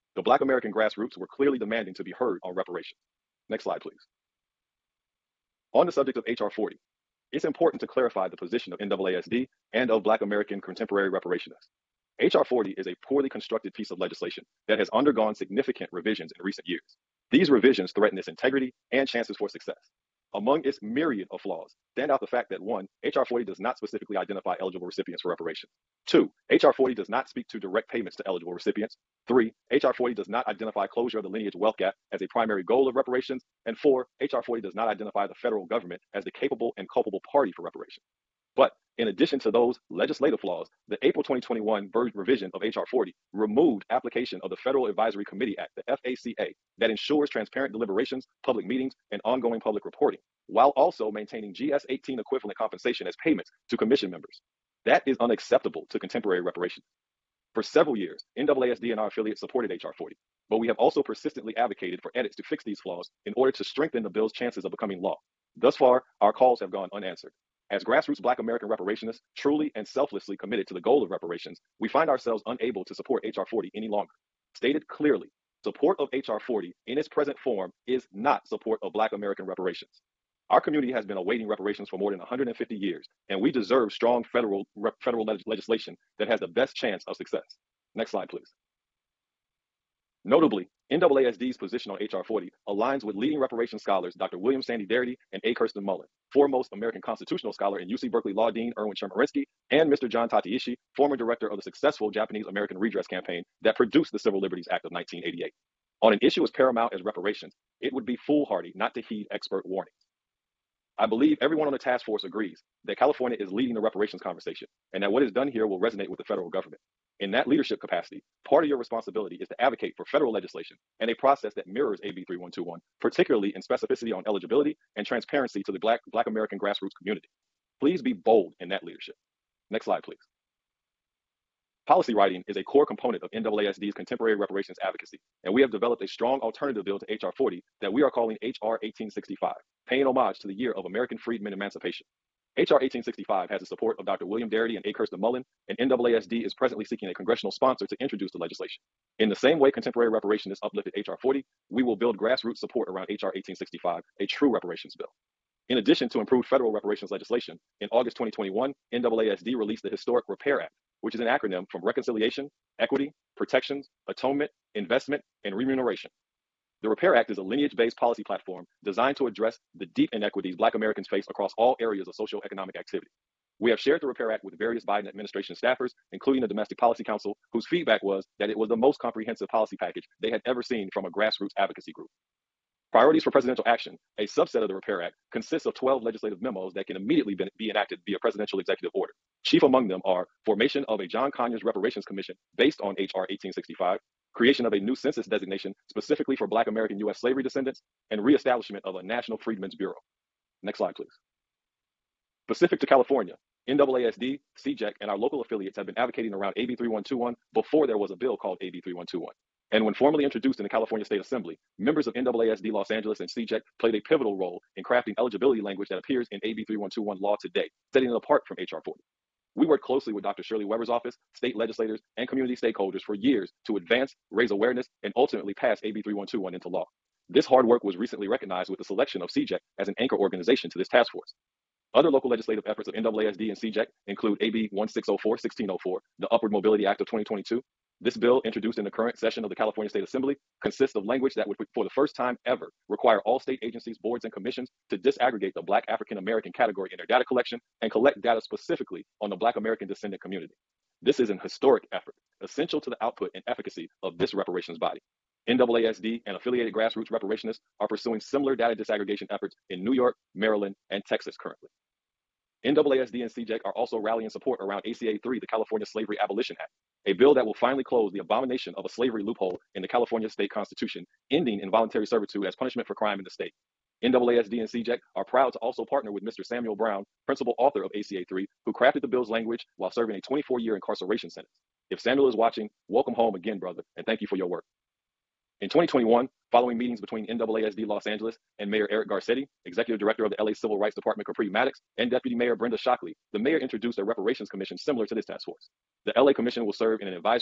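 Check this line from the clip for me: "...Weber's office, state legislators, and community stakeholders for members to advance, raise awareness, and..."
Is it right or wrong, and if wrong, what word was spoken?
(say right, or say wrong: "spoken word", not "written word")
wrong: "years", not "members".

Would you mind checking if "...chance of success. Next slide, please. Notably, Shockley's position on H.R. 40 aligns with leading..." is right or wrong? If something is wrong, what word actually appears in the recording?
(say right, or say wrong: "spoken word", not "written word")
wrong: "NAASD", not "Shockley".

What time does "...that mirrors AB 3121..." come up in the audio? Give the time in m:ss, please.
2:01.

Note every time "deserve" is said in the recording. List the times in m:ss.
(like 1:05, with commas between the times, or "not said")
1:23.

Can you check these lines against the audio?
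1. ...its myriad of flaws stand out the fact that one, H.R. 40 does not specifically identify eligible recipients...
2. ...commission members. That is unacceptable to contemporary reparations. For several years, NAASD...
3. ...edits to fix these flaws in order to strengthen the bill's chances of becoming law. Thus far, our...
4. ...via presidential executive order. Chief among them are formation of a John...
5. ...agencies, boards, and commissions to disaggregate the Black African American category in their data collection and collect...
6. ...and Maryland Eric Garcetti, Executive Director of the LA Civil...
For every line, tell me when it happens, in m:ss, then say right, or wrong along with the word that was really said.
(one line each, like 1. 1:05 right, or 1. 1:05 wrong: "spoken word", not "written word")
1. 0:20 right
2. 0:53 right
3. 1:02 right
4. 3:08 right
5. 4:03 right
6. 4:48 wrong: "Mayor", not "Maryland".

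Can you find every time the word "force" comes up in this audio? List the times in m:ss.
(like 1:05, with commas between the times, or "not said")
1:52, 3:51, 4:55.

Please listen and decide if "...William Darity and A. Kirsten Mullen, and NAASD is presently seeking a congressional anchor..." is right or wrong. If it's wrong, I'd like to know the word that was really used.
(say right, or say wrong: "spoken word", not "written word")
wrong: "sponsor", not "anchor".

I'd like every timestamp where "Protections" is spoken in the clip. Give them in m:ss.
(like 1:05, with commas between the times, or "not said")
2:43.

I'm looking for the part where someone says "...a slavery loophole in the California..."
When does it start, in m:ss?
4:28.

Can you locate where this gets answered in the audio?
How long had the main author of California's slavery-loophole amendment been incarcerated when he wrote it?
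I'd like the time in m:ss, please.
4:40.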